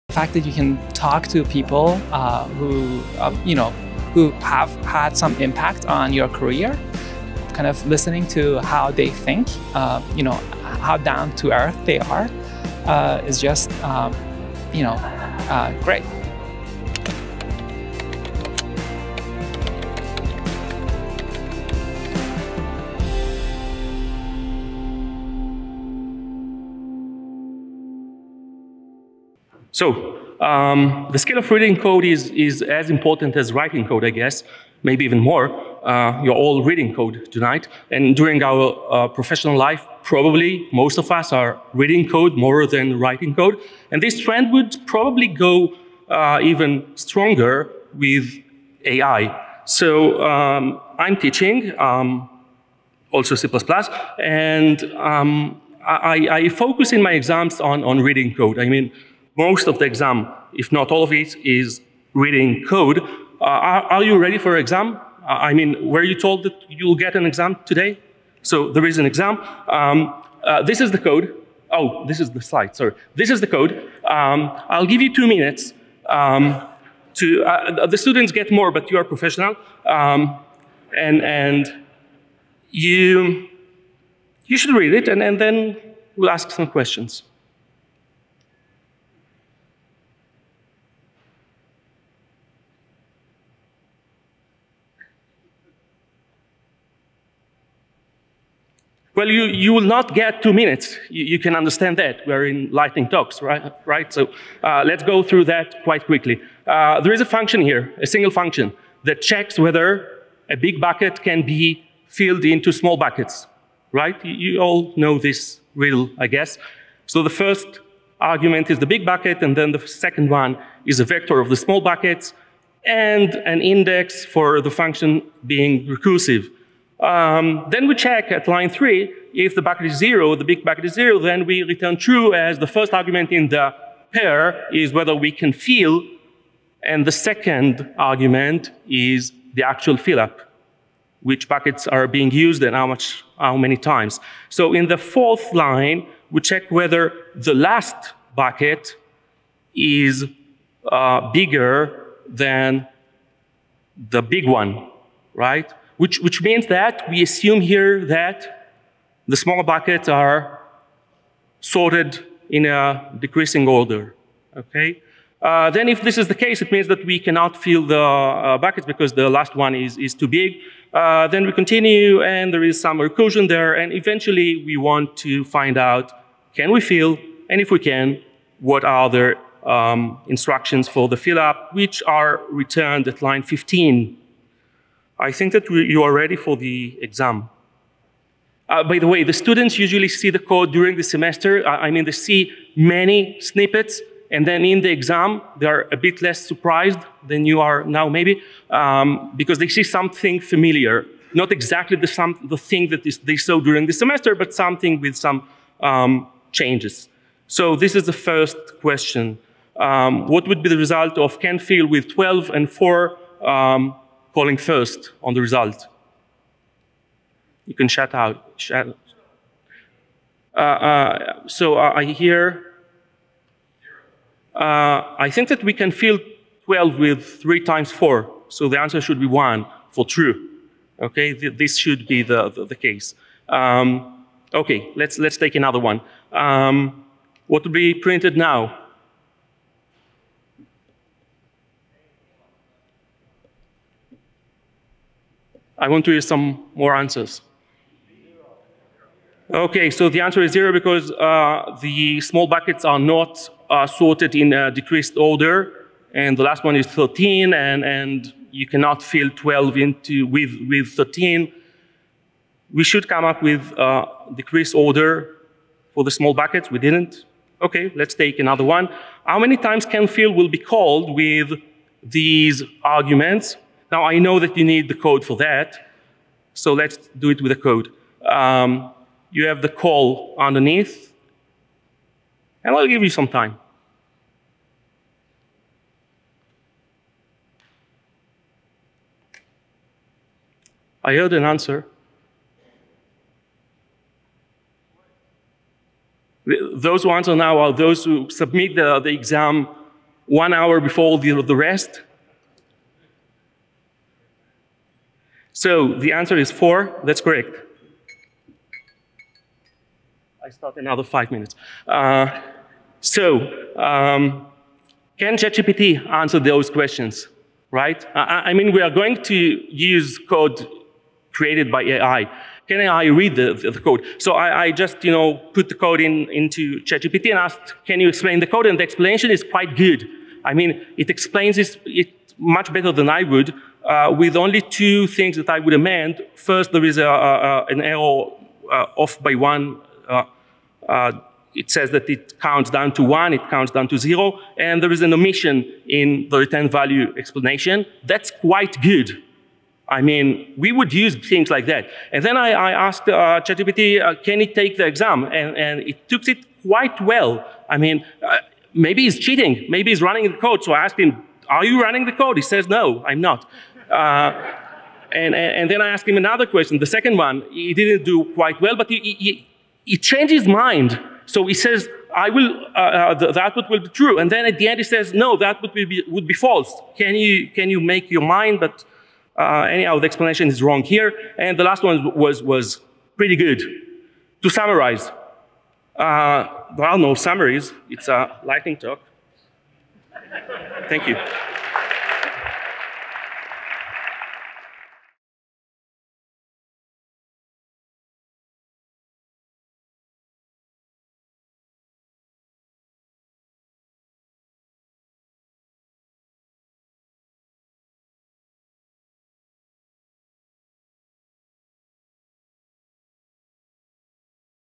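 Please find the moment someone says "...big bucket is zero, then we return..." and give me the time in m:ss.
2:10.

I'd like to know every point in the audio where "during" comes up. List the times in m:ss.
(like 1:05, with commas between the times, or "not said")
0:38, 3:10, 3:23.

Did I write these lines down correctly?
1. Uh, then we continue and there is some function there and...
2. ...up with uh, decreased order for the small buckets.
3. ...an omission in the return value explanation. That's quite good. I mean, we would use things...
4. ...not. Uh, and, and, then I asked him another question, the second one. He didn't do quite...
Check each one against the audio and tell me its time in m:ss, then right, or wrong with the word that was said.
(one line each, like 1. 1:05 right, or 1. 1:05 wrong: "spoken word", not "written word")
1. 2:50 wrong: "recursion", not "function"
2. 4:23 right
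3. 5:45 right
4. 6:03 right.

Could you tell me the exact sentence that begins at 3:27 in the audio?
So this is the first question.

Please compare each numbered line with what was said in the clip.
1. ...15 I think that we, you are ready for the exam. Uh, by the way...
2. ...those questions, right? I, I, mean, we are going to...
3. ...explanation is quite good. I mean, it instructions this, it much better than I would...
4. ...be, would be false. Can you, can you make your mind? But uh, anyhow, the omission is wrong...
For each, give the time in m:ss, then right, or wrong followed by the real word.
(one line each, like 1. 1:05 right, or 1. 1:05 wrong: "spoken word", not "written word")
1. 3:03 right
2. 5:16 right
3. 5:28 wrong: "explains", not "instructions"
4. 6:15 wrong: "explanation", not "omission".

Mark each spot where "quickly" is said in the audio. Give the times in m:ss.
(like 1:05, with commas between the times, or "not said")
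1:46.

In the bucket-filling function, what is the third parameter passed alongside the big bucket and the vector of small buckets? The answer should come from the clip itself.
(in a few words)
an index.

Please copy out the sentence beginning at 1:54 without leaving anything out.
You, you all know this riddle, I guess.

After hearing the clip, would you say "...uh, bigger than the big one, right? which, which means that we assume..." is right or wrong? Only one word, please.
right.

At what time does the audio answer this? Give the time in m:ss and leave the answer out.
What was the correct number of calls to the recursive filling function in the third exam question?
5:06.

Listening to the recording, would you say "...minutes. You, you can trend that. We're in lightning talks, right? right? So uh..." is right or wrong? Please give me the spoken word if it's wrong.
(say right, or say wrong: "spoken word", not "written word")
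wrong: "understand", not "trend".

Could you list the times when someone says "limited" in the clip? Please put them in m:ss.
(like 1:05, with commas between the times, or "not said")
not said.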